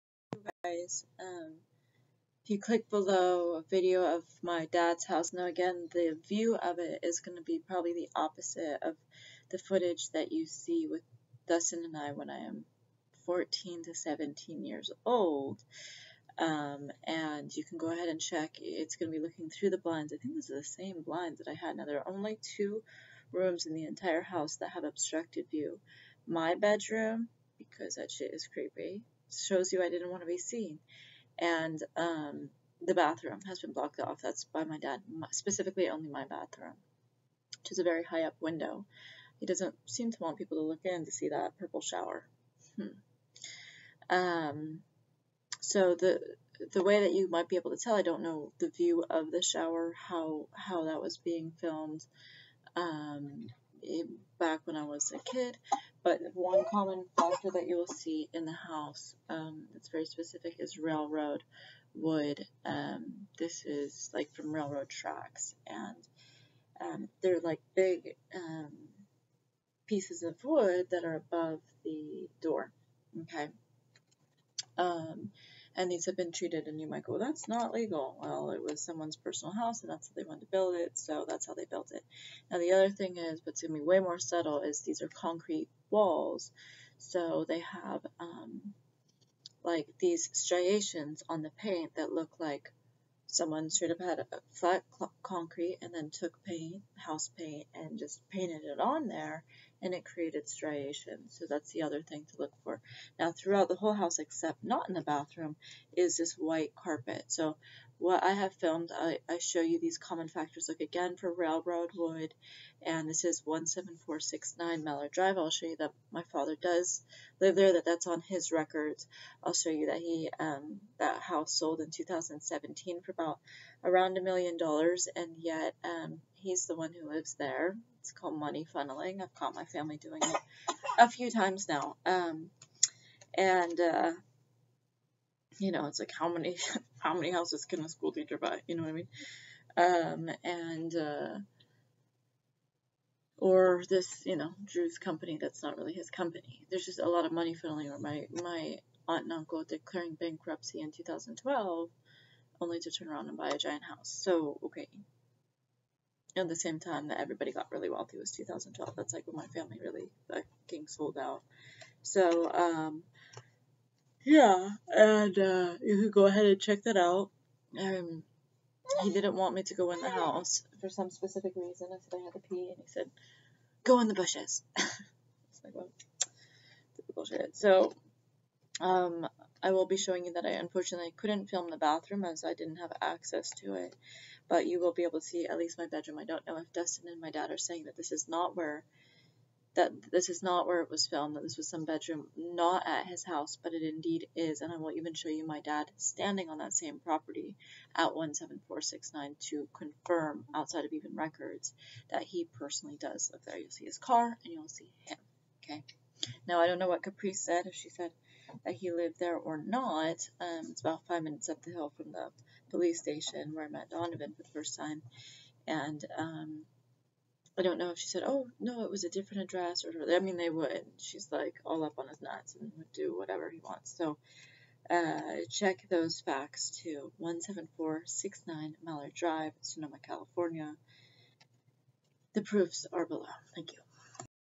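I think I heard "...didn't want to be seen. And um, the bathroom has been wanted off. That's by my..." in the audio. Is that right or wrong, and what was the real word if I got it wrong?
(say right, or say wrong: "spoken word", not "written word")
wrong: "blocked", not "wanted".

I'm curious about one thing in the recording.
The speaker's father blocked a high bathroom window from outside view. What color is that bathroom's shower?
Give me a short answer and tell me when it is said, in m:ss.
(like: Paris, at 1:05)
purple, at 0:41.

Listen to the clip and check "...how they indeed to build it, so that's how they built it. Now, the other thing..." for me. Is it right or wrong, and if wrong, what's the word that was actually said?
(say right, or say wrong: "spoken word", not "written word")
wrong: "wanted", not "indeed".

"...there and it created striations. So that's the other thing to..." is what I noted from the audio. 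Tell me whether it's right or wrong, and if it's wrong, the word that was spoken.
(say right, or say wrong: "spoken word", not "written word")
right.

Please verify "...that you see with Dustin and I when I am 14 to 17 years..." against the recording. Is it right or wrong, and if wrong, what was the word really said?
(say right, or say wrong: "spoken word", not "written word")
right.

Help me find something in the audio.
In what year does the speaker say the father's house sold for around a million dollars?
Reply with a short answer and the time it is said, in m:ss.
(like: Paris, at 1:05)
2017, at 2:01.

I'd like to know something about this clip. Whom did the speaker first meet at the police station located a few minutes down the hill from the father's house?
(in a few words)
Donovan.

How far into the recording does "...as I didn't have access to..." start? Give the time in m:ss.
3:02.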